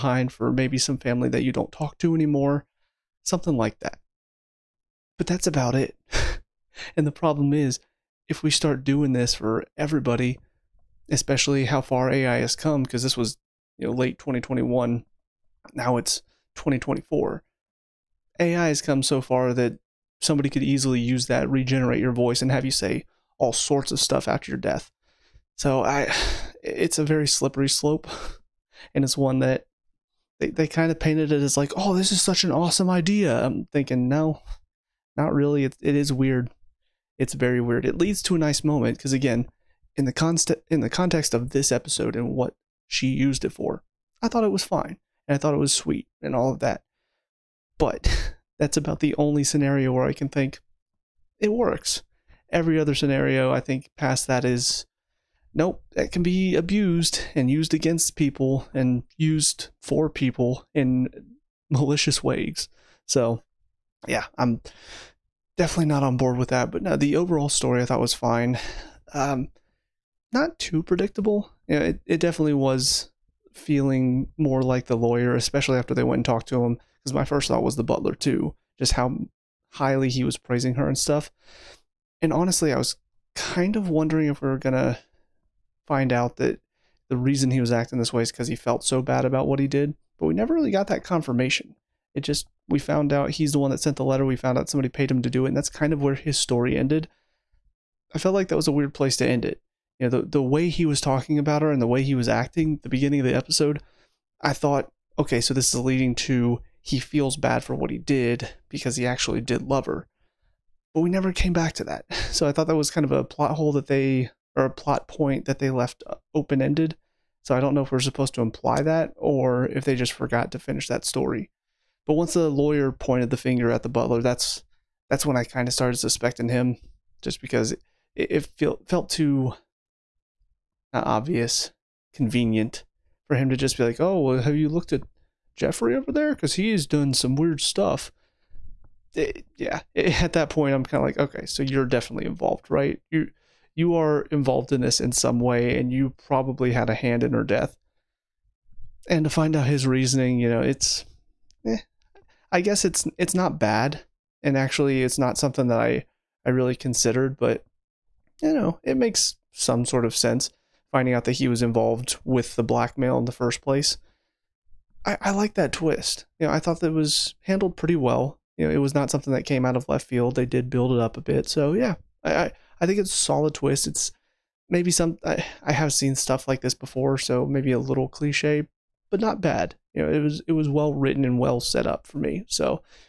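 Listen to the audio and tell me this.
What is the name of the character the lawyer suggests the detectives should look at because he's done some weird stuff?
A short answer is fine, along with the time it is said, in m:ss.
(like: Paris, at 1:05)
Jeffrey, at 2:15.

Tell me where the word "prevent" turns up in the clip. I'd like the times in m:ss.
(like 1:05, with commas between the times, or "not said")
not said.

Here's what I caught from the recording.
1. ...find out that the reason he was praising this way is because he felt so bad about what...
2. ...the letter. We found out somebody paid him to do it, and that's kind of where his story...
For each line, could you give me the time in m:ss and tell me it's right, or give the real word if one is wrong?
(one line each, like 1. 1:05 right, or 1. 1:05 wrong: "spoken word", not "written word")
1. 1:25 wrong: "acting", not "praising"
2. 1:33 right.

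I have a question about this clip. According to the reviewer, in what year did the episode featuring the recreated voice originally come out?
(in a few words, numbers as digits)
2021.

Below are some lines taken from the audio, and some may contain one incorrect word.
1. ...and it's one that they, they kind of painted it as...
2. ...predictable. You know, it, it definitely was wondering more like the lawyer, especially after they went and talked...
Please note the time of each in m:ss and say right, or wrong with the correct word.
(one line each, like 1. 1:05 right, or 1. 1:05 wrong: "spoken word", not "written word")
1. 0:28 right
2. 1:10 wrong: "feeling", not "wondering".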